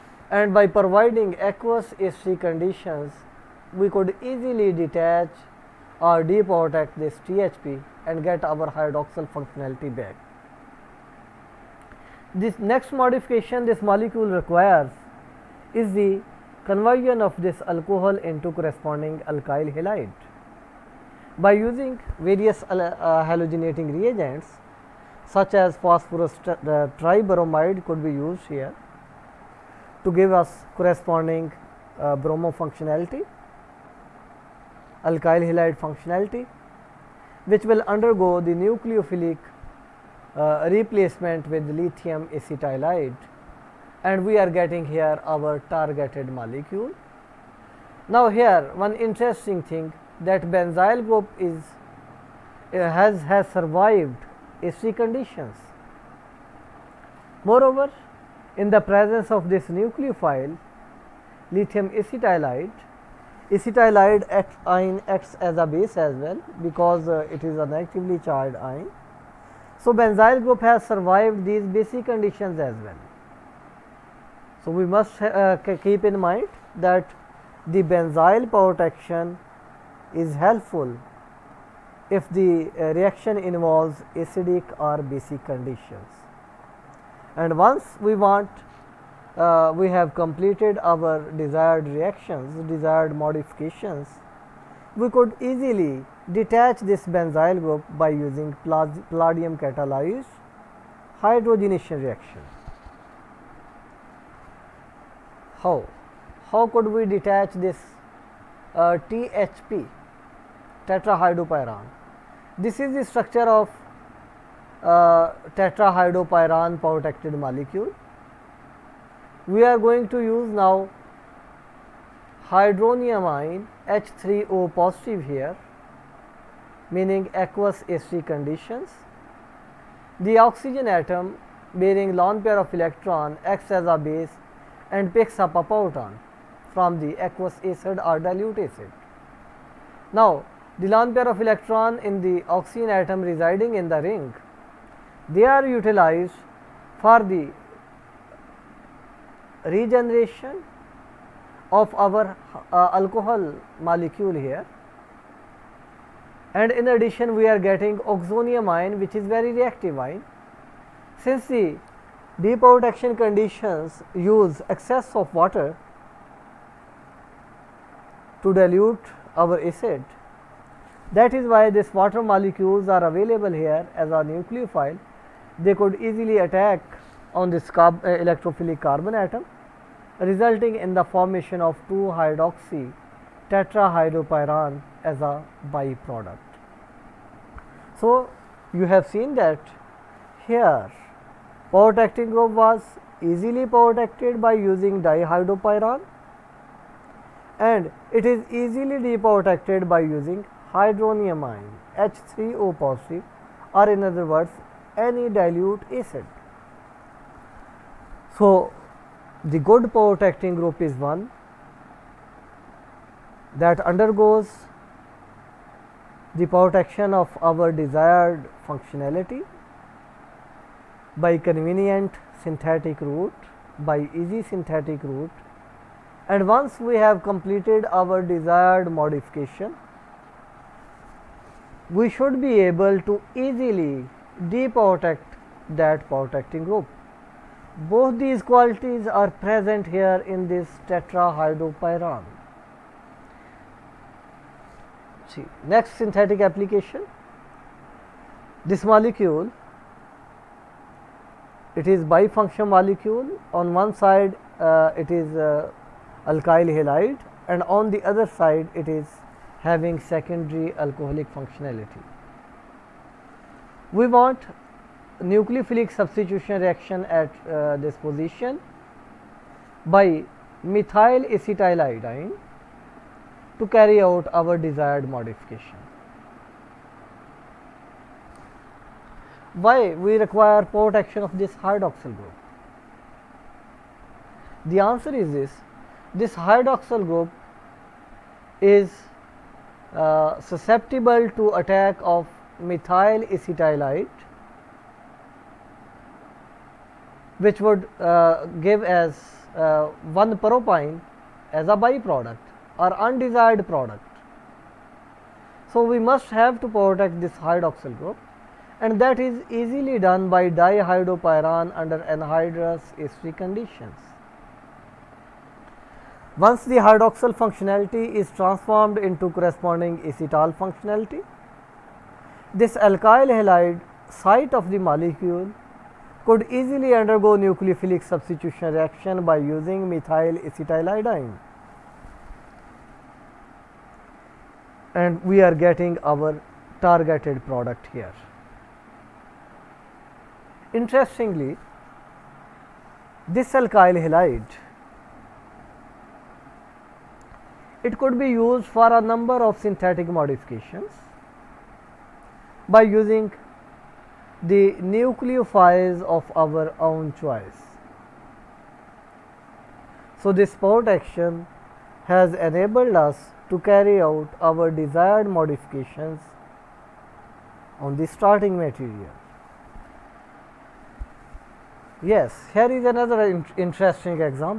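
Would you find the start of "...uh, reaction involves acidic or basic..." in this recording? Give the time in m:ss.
1:22.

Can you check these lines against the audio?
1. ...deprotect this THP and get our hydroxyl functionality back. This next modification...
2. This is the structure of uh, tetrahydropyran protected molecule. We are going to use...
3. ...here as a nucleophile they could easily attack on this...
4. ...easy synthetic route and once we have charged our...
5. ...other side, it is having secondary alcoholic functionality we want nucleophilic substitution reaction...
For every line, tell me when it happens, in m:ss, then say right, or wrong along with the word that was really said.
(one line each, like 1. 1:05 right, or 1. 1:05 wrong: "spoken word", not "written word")
1. 0:06 right
2. 1:52 right
3. 2:53 right
4. 3:44 wrong: "completed", not "charged"
5. 4:18 right.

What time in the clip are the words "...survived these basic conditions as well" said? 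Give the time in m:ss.
1:10.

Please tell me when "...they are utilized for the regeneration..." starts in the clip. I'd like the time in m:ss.
2:25.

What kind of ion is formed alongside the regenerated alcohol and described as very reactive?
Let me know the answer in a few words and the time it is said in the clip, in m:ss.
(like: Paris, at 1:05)
oxonium ion, at 2:38.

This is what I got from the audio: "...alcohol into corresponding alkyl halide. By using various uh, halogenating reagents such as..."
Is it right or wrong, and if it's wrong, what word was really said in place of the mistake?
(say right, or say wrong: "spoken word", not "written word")
right.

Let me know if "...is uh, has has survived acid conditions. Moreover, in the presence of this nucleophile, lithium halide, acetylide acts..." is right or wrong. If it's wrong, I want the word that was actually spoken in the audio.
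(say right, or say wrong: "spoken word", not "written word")
wrong: "acetylide", not "halide".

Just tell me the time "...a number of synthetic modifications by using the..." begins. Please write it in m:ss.
5:48.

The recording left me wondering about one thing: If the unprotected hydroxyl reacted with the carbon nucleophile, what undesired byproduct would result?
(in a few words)
1 propyne.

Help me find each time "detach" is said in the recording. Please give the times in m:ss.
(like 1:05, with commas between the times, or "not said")
0:04, 1:36, 1:47.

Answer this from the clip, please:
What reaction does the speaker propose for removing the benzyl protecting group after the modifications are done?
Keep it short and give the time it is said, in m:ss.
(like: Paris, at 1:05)
palladium catalyzed hydrogenation, at 1:38.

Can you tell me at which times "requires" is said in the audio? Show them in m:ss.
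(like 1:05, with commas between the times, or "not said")
0:14, 4:40.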